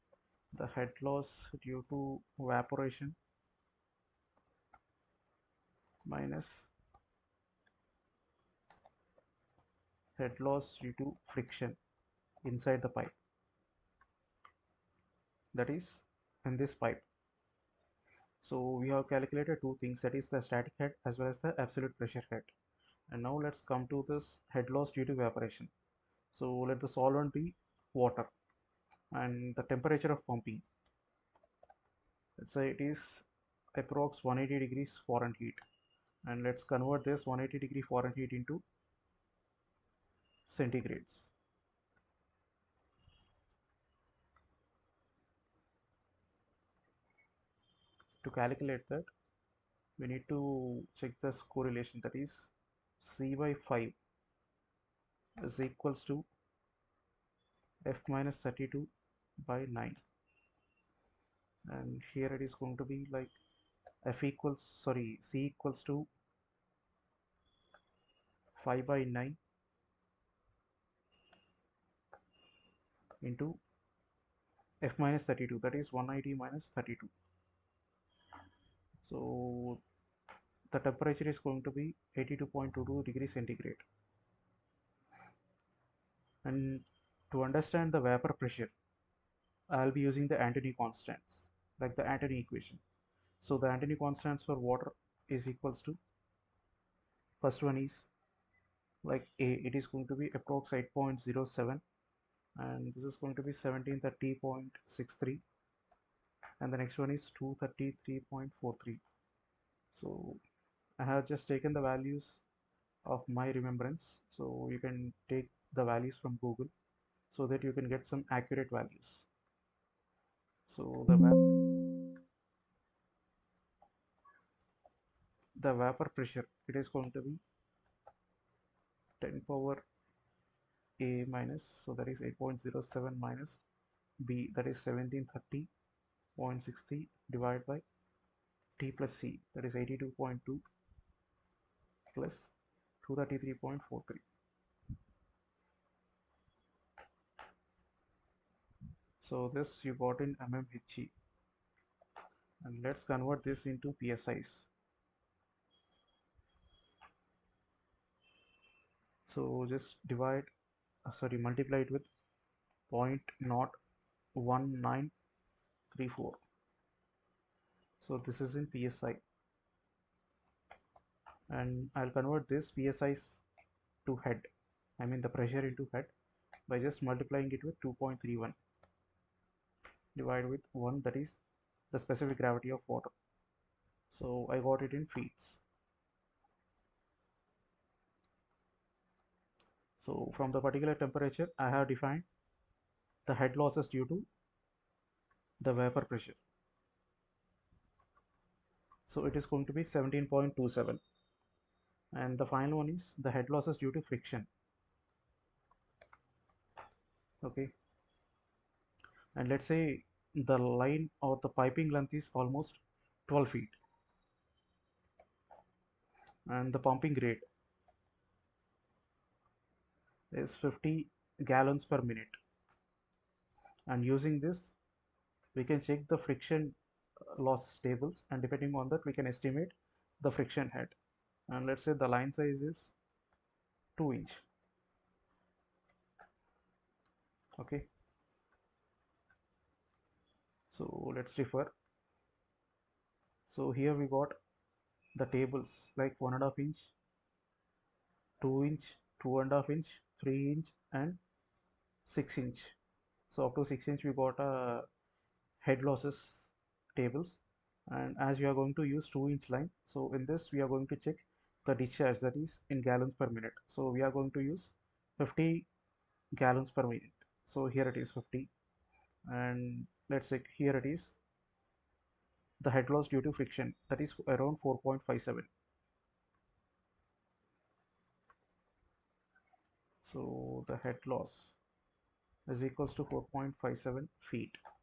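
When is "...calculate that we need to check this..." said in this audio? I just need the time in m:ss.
0:48.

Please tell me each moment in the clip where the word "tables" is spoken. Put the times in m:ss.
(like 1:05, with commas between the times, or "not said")
3:47, 4:05, 4:16.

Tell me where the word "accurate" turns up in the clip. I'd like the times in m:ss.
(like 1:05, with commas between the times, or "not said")
1:58.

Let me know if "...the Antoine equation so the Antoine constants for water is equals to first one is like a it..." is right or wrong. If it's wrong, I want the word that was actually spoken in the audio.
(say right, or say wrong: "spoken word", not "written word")
right.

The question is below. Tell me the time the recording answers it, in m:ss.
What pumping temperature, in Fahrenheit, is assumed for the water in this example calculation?
0:34.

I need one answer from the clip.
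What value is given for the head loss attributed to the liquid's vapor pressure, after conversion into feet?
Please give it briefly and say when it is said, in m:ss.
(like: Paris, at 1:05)
17.27, at 3:19.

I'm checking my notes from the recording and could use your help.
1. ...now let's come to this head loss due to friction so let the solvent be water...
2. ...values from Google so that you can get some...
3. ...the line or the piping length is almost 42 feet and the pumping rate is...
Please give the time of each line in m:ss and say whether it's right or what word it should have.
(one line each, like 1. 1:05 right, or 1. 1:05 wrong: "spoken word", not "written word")
1. 0:23 wrong: "evaporation", not "friction"
2. 1:55 right
3. 3:30 wrong: "12", not "42".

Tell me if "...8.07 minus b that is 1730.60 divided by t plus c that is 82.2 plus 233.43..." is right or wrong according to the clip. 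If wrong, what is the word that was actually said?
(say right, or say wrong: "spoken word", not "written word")
right.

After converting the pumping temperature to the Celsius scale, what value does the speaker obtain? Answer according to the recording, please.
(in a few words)
82.22 degrees centigrade.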